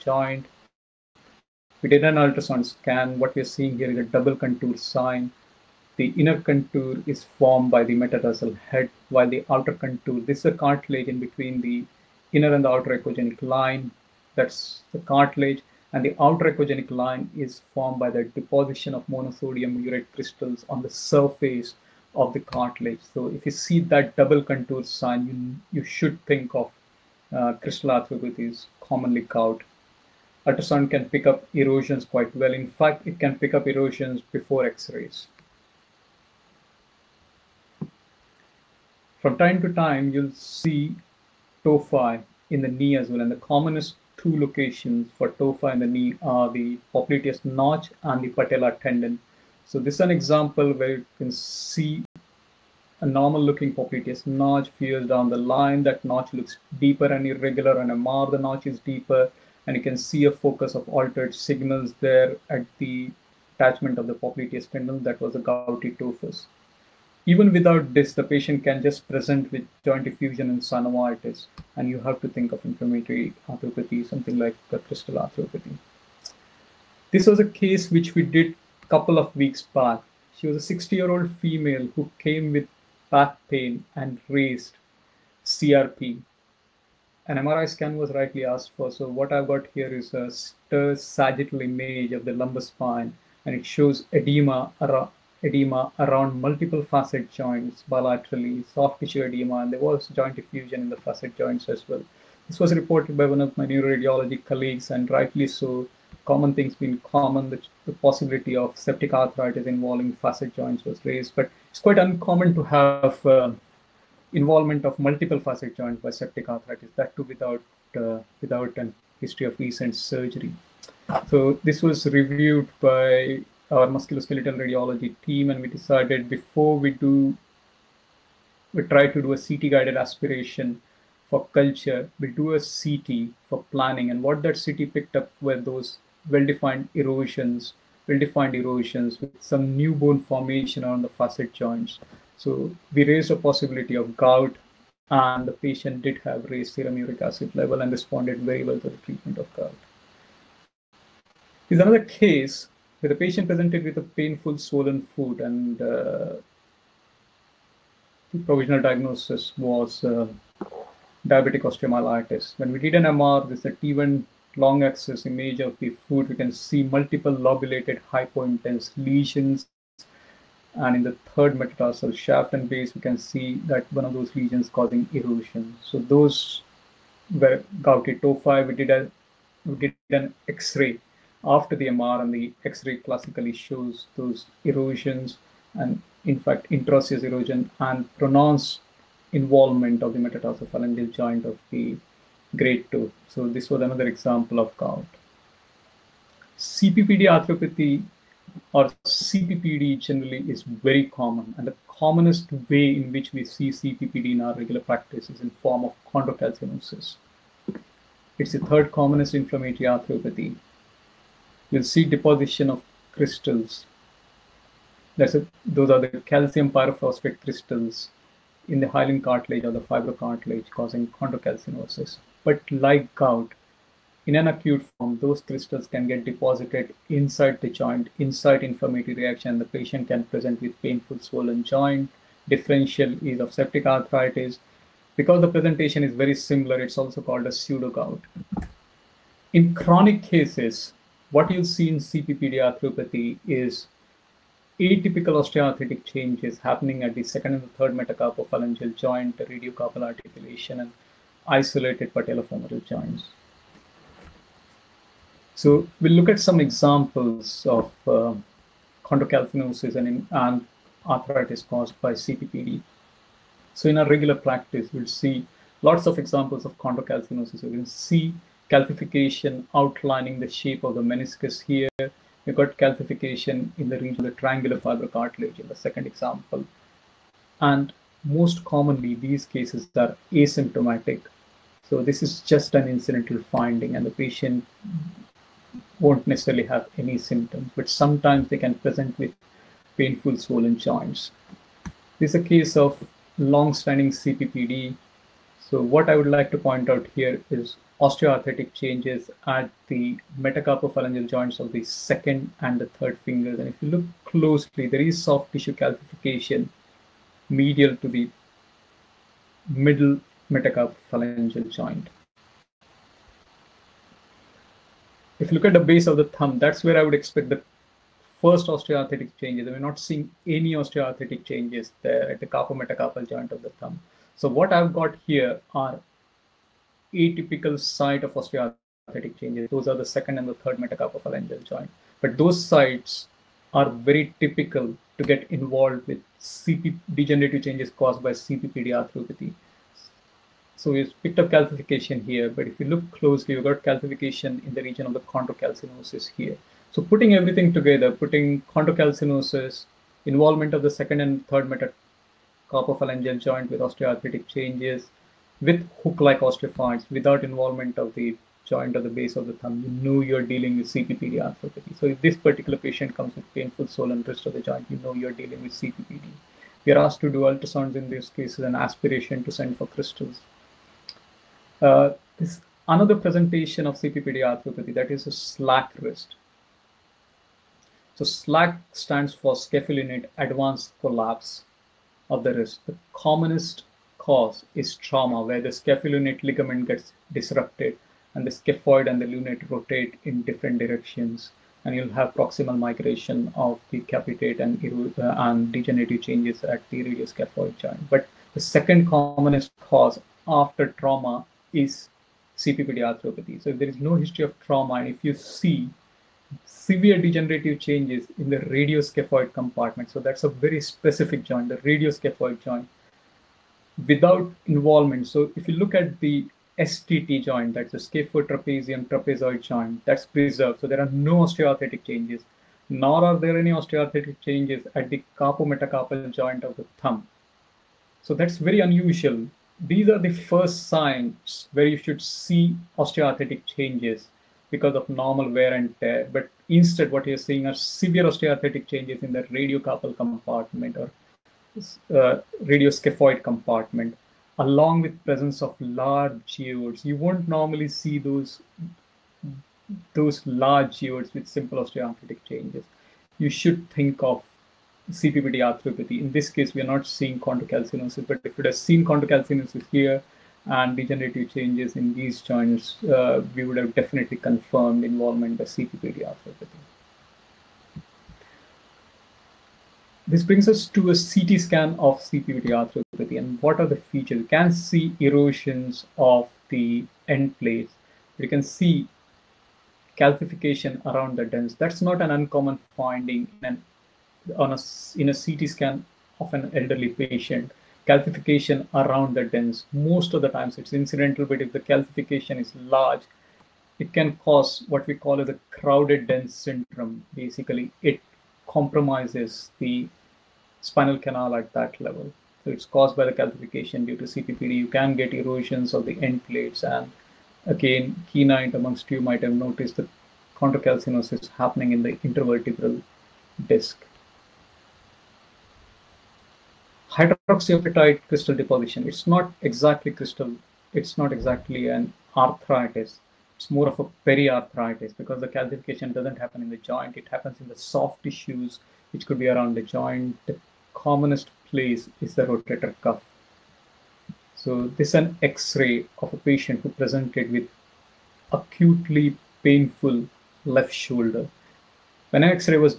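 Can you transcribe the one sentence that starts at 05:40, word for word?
So we've picked up calcification here, but if you look closely, you've got calcification in the region of the chondrocalcinosis here.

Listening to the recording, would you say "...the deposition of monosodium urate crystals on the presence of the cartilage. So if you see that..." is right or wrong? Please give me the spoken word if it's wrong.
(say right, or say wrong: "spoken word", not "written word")
wrong: "surface", not "presence".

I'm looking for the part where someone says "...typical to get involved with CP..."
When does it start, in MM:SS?
05:34.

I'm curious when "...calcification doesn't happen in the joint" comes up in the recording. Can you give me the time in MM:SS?
08:45.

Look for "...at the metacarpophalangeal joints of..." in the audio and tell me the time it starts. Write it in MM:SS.
04:59.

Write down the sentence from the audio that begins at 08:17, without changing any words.
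Basically, it compromises the spinal canal at that level.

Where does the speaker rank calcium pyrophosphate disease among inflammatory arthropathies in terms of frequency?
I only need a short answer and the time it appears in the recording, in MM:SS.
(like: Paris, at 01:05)
Third commonest, at 03:28.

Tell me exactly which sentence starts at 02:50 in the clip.
And in the third metatarsal shaft and base, we can see that one of those lesions causing erosion.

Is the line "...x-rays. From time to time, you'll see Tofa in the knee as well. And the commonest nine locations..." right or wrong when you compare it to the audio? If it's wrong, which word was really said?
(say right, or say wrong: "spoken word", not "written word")
wrong: "two", not "nine".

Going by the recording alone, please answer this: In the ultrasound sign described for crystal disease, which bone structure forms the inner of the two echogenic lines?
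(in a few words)
Metatarsal head.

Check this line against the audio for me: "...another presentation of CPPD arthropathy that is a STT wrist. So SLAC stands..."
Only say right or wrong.
wrong.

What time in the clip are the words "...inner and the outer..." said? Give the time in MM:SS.
00:12.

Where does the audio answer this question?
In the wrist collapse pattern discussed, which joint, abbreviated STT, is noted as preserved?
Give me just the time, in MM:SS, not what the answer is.
06:57.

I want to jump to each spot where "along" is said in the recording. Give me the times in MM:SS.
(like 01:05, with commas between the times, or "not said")
07:24.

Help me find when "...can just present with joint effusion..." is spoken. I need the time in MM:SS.
01:08.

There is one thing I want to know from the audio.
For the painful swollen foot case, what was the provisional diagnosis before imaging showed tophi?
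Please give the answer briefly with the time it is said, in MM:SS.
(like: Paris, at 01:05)
Diabetic osteomyelitis, at 02:41.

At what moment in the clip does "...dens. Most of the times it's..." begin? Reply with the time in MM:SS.
08:09.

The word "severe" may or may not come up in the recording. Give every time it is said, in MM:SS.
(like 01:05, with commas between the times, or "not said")
06:46, 07:17.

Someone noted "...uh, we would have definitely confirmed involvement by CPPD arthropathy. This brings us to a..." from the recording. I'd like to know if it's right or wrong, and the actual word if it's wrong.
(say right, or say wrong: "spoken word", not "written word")
right.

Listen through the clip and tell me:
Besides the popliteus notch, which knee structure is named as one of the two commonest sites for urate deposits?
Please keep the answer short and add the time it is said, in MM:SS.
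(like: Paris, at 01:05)
Patella tendon, at 00:48.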